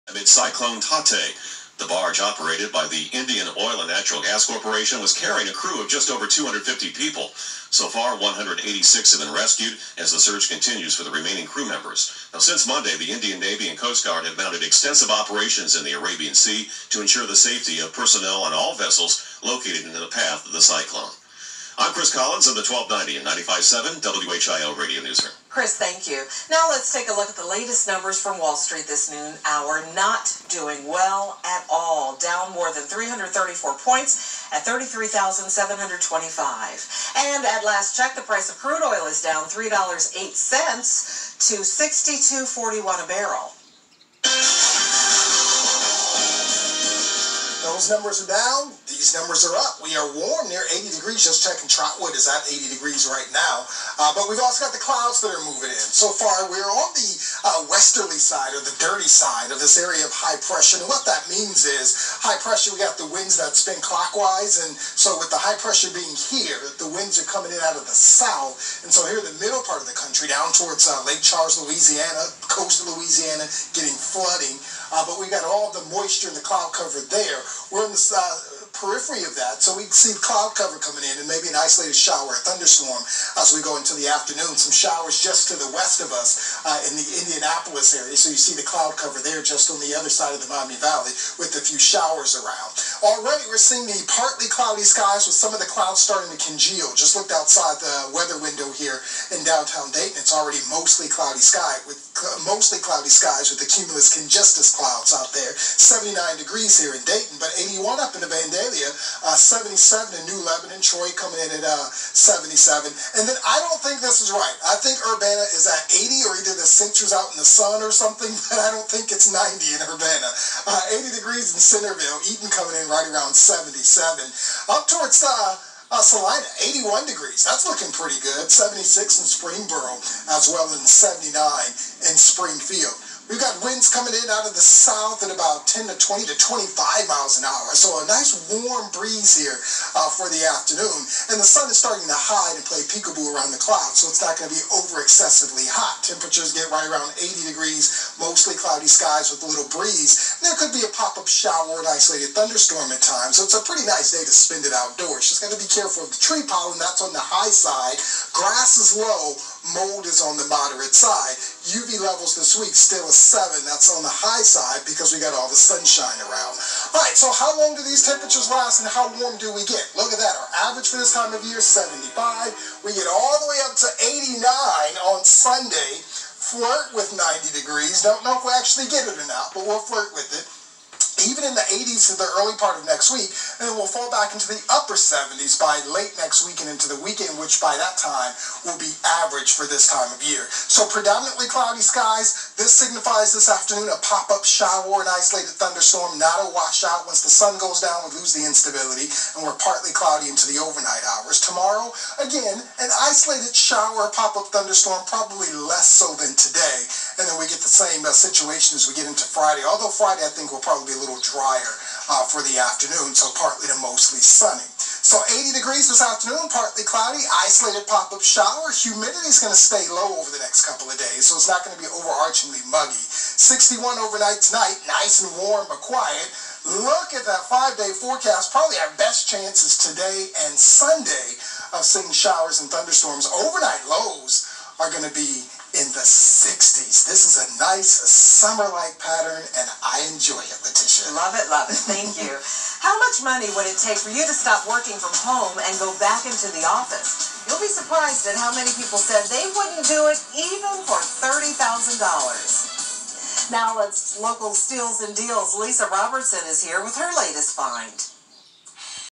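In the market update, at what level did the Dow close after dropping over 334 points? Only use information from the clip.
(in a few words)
33,725.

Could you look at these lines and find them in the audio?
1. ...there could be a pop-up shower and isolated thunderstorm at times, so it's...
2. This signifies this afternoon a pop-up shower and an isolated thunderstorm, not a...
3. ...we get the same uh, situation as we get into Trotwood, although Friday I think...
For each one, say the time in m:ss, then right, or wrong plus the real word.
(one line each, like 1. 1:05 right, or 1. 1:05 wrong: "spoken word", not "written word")
1. 2:30 right
2. 3:12 right
3. 3:27 wrong: "Friday", not "Trotwood".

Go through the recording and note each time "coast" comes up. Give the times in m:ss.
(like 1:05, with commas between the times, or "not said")
0:13, 1:12.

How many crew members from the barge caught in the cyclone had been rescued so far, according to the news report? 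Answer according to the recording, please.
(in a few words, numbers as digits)
186.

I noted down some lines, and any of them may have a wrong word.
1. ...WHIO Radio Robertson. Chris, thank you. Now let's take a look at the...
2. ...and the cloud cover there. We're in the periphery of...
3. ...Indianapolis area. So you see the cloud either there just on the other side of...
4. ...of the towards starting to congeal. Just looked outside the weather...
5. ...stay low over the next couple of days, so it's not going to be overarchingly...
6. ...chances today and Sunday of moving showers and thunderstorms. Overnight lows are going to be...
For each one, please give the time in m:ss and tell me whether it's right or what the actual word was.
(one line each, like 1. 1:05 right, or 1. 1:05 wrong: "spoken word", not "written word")
1. 0:24 wrong: "Newsroom", not "Robertson"
2. 1:16 right
3. 1:27 wrong: "cover", not "either"
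4. 1:35 wrong: "clouds", not "towards"
5. 3:39 right
6. 3:49 wrong: "seeing", not "moving".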